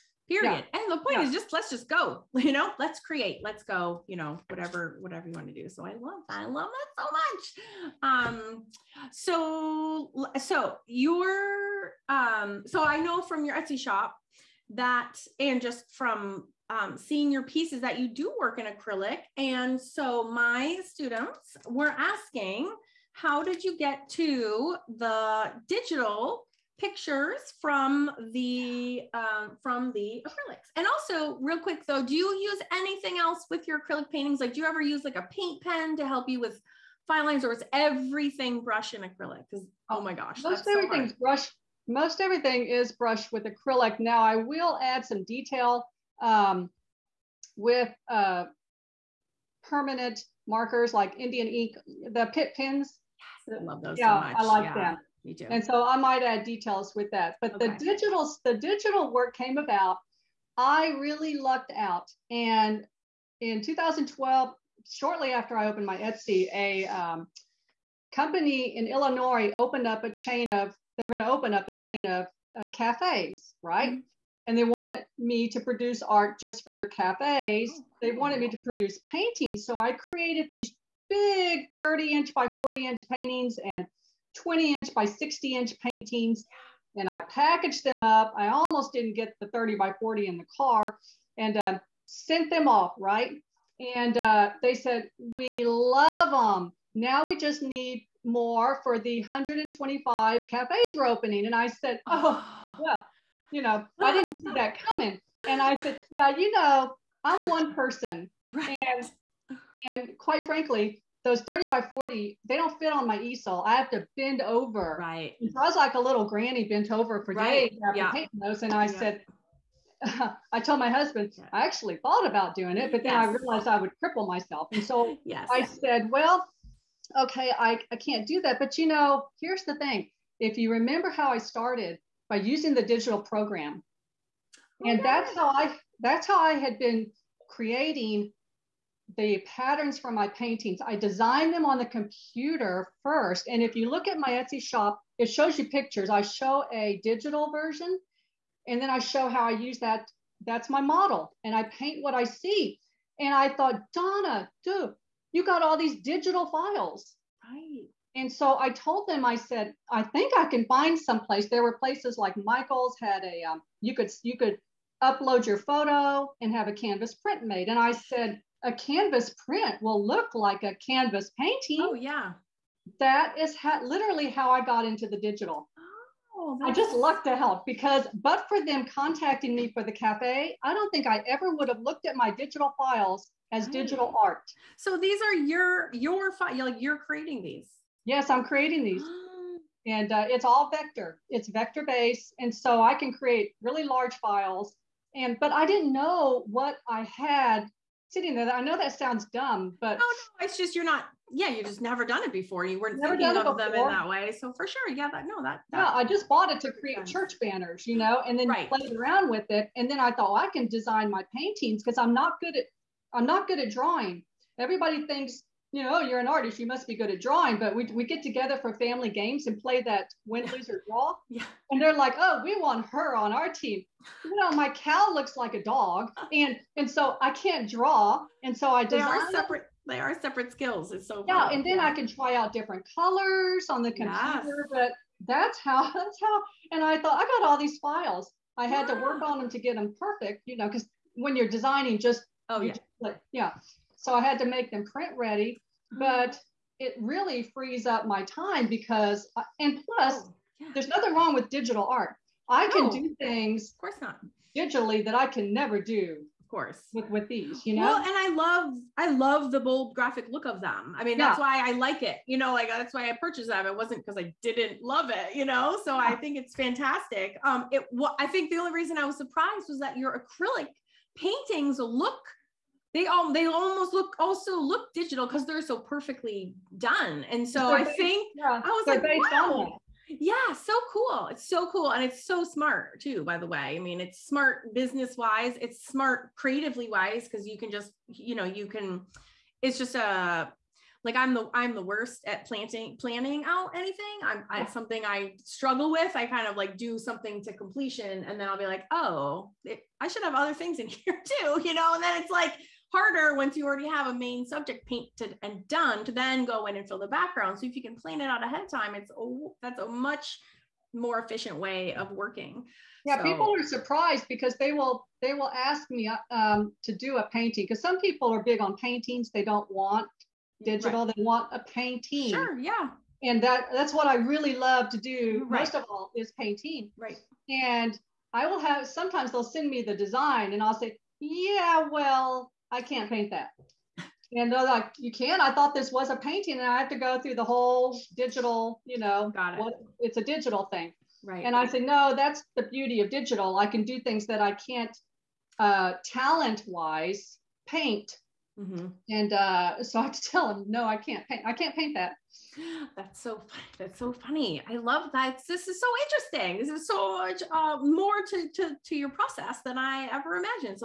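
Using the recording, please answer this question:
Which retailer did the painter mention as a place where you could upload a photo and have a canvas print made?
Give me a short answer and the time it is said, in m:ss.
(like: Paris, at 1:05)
Michael's, at 2:42.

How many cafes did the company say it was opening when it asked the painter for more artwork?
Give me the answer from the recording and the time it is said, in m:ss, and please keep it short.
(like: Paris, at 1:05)
125, at 1:39.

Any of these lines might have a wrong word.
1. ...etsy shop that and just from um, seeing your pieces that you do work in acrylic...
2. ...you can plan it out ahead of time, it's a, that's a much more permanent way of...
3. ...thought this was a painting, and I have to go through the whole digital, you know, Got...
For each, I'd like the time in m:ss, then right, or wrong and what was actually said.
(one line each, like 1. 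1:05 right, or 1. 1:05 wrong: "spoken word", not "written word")
1. 0:13 right
2. 5:07 wrong: "efficient", not "permanent"
3. 5:35 right.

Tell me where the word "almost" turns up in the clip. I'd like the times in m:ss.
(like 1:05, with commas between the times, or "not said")
1:28, 4:33.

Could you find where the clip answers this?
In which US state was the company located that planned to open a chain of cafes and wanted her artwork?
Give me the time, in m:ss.
1:08.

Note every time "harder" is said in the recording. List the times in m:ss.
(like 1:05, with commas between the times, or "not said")
5:02.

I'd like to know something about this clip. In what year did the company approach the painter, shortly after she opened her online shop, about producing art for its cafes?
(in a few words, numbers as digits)
2012.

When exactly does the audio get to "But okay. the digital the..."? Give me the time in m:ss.
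0:57.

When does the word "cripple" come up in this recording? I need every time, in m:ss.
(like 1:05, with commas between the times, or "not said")
2:04.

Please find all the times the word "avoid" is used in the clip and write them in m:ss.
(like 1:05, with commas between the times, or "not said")
not said.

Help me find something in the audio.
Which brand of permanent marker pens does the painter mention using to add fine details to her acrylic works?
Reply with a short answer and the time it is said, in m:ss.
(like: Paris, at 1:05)
Pitt pens, at 0:52.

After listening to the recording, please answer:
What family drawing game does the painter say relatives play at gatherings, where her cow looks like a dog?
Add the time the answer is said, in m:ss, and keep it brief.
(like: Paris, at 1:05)
Win, Lose, or Draw, at 3:40.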